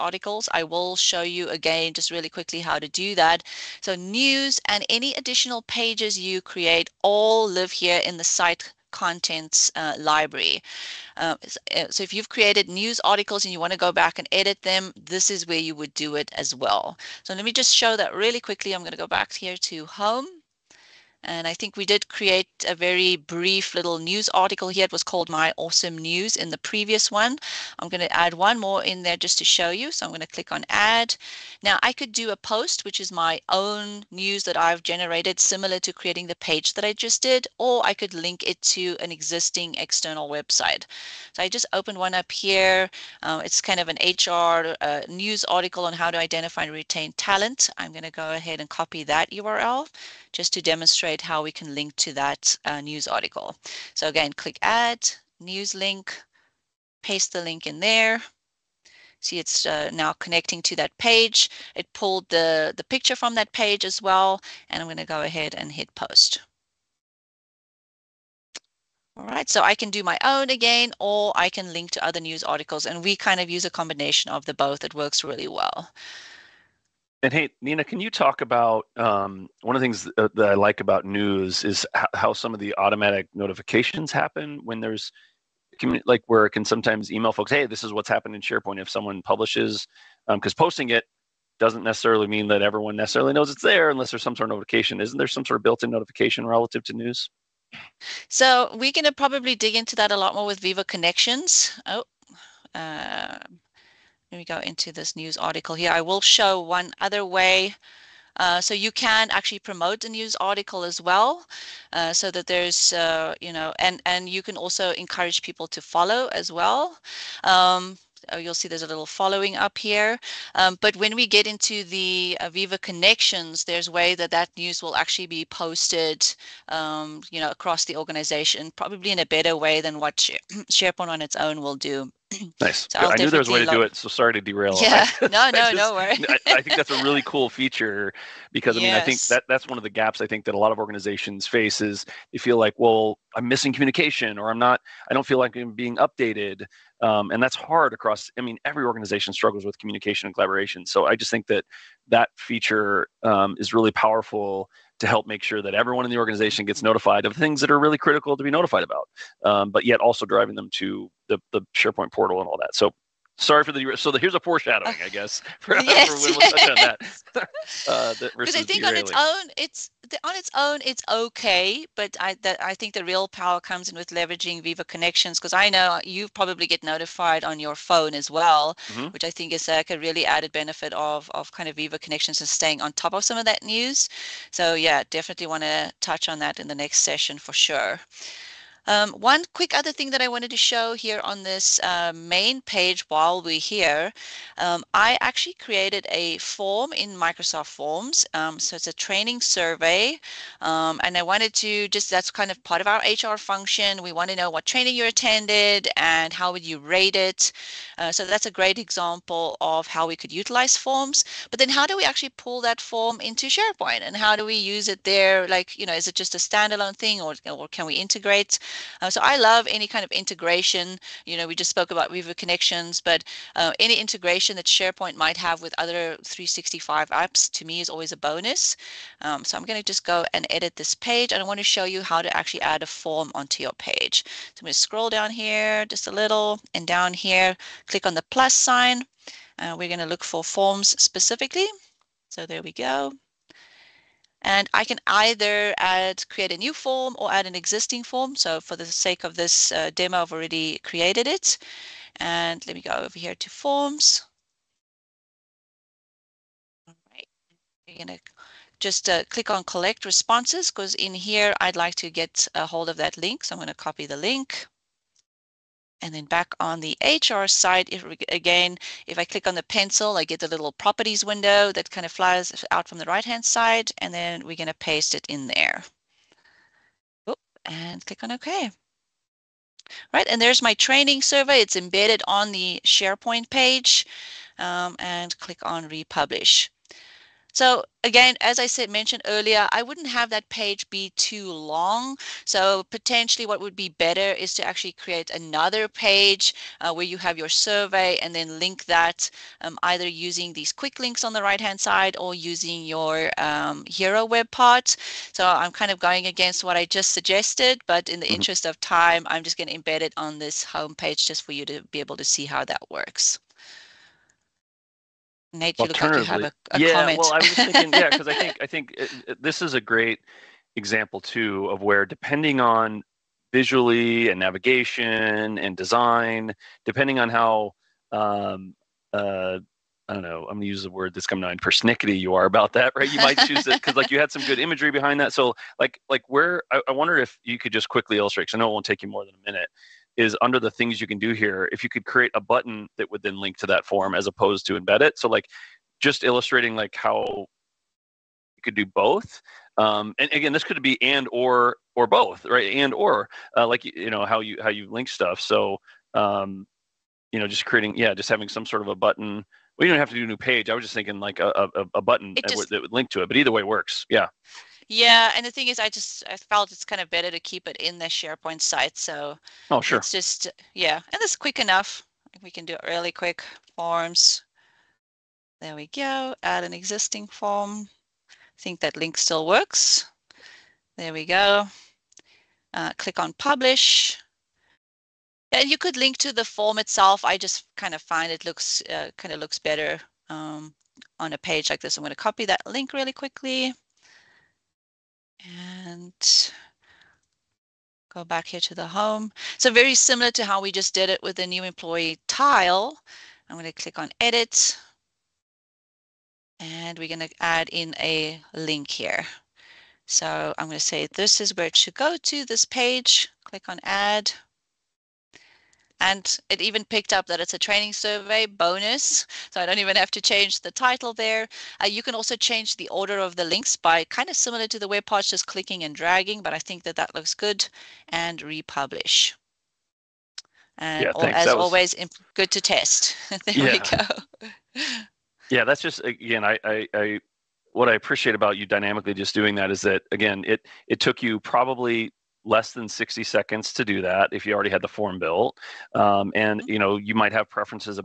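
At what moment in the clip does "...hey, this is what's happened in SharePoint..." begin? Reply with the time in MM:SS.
01:27.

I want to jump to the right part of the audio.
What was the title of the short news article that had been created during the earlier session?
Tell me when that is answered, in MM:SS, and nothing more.
00:25.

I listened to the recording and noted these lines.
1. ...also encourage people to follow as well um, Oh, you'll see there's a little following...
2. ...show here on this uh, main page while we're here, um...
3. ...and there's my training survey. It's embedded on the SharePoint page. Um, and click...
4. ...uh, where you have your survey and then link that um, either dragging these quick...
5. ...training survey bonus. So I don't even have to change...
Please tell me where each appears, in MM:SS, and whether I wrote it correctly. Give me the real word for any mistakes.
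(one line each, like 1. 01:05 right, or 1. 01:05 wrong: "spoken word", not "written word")
1. 01:54 right
2. 03:10 right
3. 04:40 right
4. 04:56 wrong: "using", not "dragging"
5. 06:57 right.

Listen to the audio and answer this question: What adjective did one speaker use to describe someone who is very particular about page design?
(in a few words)
Persnickety.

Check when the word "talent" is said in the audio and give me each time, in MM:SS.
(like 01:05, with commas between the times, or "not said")
00:47.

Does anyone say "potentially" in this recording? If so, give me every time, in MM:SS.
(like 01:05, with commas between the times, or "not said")
04:52.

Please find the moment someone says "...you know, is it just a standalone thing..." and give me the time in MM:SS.
03:35.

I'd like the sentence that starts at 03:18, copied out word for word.
Um, so it's a training survey.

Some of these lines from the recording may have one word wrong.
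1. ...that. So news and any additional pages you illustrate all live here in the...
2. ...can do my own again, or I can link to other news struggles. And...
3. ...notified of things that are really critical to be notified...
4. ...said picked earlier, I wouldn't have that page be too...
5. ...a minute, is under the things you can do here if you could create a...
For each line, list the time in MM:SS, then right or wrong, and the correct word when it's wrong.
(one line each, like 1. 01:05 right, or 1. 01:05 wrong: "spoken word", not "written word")
1. 00:03 wrong: "create", not "illustrate"
2. 01:09 wrong: "articles", not "struggles"
3. 02:36 right
4. 04:48 wrong: "mentioned", not "picked"
5. 05:39 right.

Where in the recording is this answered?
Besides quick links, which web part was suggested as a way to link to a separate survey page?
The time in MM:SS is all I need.
05:03.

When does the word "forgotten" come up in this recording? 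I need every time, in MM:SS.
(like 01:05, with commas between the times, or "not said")
not said.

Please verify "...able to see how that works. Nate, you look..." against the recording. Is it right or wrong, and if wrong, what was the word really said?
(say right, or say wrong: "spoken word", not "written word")
right.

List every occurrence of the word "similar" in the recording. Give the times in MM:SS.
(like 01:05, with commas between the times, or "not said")
00:35, 06:39, 07:04.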